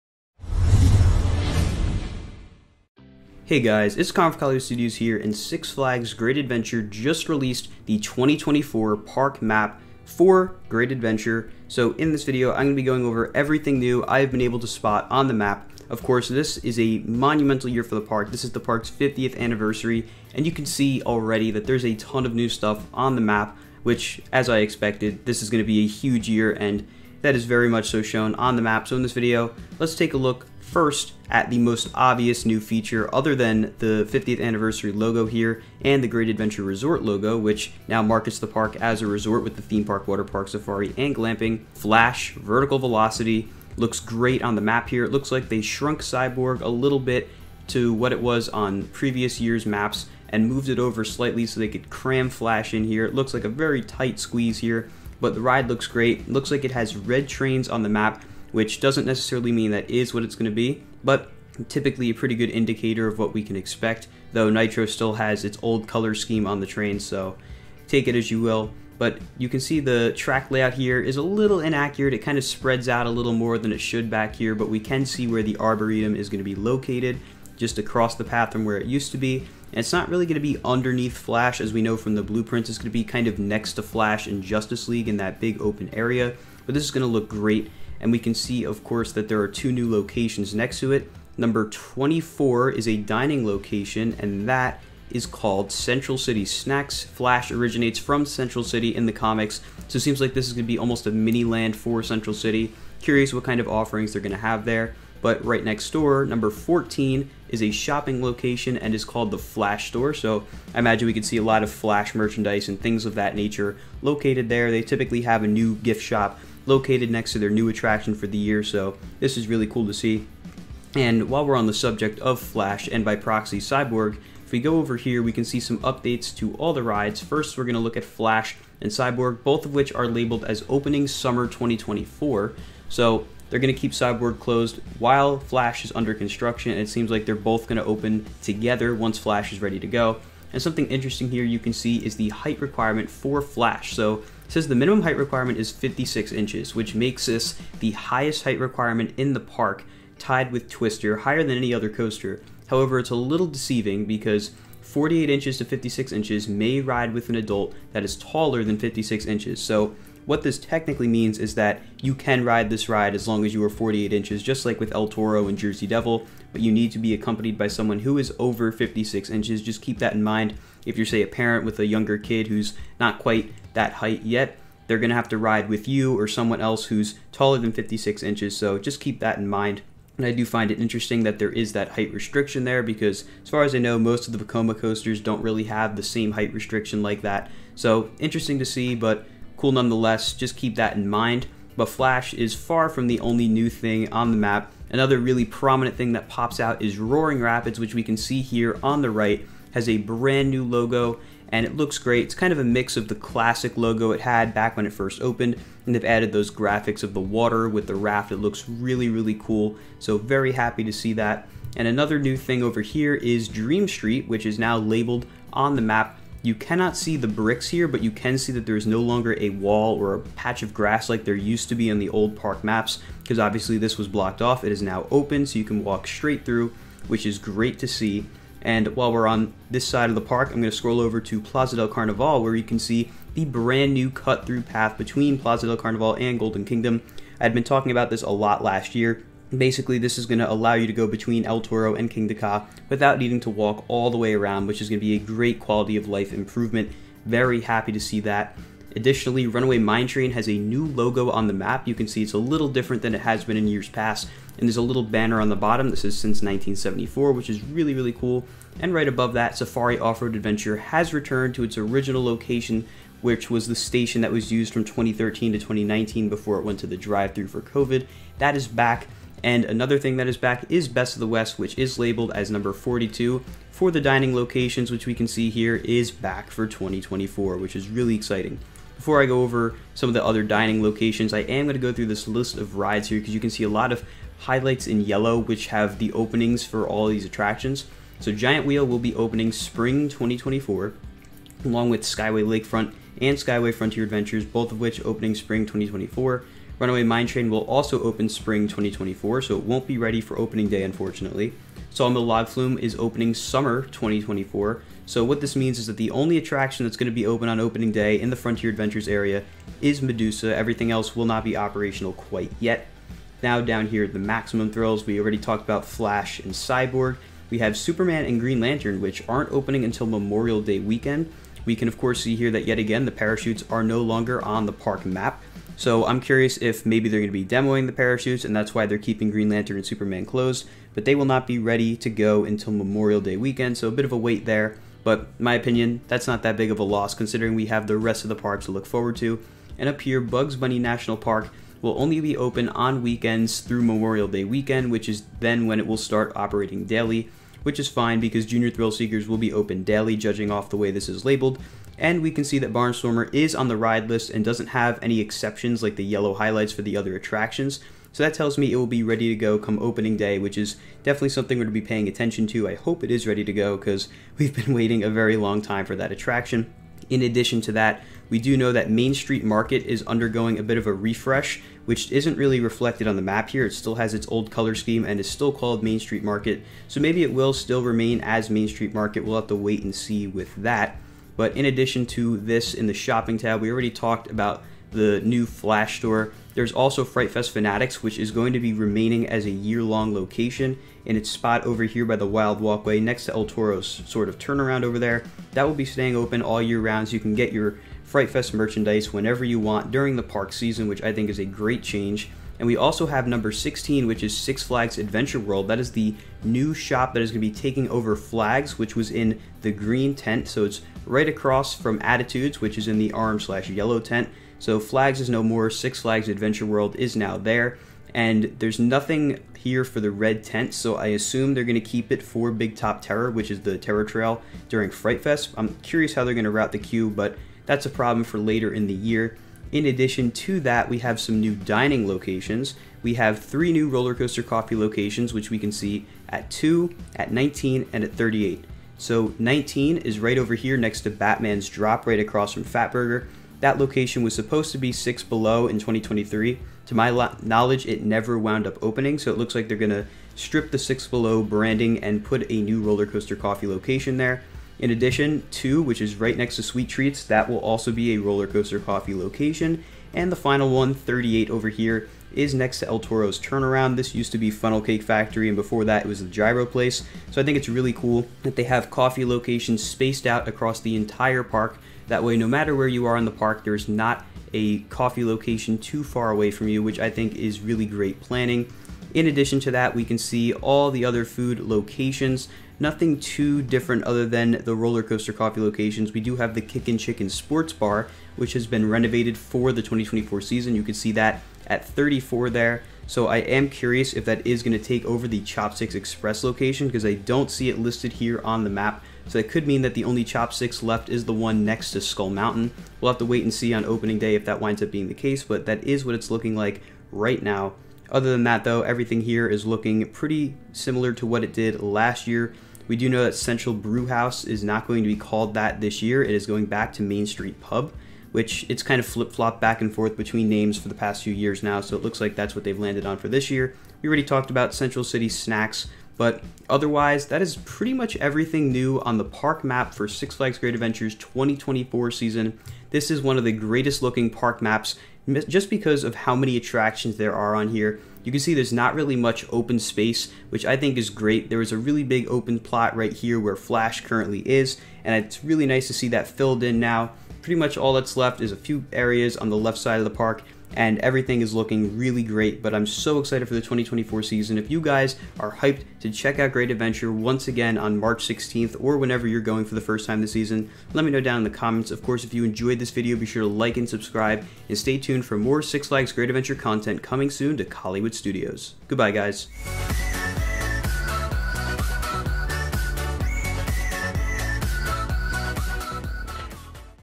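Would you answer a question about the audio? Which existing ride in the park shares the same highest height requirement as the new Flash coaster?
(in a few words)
Twister.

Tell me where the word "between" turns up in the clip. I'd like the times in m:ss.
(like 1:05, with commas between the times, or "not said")
3:54, 4:01, 8:40.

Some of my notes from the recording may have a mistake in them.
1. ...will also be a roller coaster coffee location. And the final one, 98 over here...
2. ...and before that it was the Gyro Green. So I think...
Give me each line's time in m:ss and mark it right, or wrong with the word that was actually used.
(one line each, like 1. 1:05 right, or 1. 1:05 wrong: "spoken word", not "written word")
1. 7:37 wrong: "38", not "98"
2. 7:45 wrong: "Place", not "Green".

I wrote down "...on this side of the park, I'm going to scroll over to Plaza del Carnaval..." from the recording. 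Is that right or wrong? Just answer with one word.
right.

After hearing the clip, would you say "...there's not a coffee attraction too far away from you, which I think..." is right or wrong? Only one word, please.
wrong.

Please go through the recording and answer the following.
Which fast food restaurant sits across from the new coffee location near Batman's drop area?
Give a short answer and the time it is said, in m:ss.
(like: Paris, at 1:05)
Fatburger, at 7:22.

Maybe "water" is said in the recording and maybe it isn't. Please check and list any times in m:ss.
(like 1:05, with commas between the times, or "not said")
0:40, 3:27.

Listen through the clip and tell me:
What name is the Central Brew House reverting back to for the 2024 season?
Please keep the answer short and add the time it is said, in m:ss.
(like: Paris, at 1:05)
Main Street Pub, at 8:37.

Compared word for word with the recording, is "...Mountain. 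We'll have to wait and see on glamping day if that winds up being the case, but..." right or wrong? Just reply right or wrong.
wrong.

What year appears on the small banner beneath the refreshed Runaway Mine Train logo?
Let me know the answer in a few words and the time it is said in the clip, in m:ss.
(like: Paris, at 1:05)
1974, at 4:16.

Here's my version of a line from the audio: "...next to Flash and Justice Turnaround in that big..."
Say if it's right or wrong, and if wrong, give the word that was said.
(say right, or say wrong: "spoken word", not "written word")
wrong: "League", not "Turnaround".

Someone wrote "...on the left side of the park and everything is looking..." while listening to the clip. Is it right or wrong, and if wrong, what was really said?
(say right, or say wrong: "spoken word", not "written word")
right.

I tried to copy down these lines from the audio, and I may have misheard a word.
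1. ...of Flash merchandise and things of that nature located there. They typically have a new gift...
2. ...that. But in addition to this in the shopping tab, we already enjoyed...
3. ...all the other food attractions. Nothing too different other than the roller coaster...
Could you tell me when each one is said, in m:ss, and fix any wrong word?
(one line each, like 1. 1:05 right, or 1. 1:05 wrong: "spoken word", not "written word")
1. 1:51 right
2. 6:20 wrong: "talked", not "enjoyed"
3. 8:00 wrong: "locations", not "attractions".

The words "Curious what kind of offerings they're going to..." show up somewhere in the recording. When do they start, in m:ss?
1:43.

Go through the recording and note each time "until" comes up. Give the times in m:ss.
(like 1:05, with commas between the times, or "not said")
5:19, 5:32.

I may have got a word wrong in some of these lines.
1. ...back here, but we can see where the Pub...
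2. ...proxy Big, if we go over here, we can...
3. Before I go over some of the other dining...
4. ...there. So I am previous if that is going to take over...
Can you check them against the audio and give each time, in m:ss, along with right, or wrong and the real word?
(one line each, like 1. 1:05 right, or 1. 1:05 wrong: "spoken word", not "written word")
1. 1:14 wrong: "Arboretum", not "Pub"
2. 2:03 wrong: "Cyborg", not "Big"
3. 4:39 right
4. 8:12 wrong: "curious", not "previous".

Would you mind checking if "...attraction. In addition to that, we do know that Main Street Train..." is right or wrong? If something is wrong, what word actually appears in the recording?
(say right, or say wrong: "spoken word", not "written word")
wrong: "Market", not "Train".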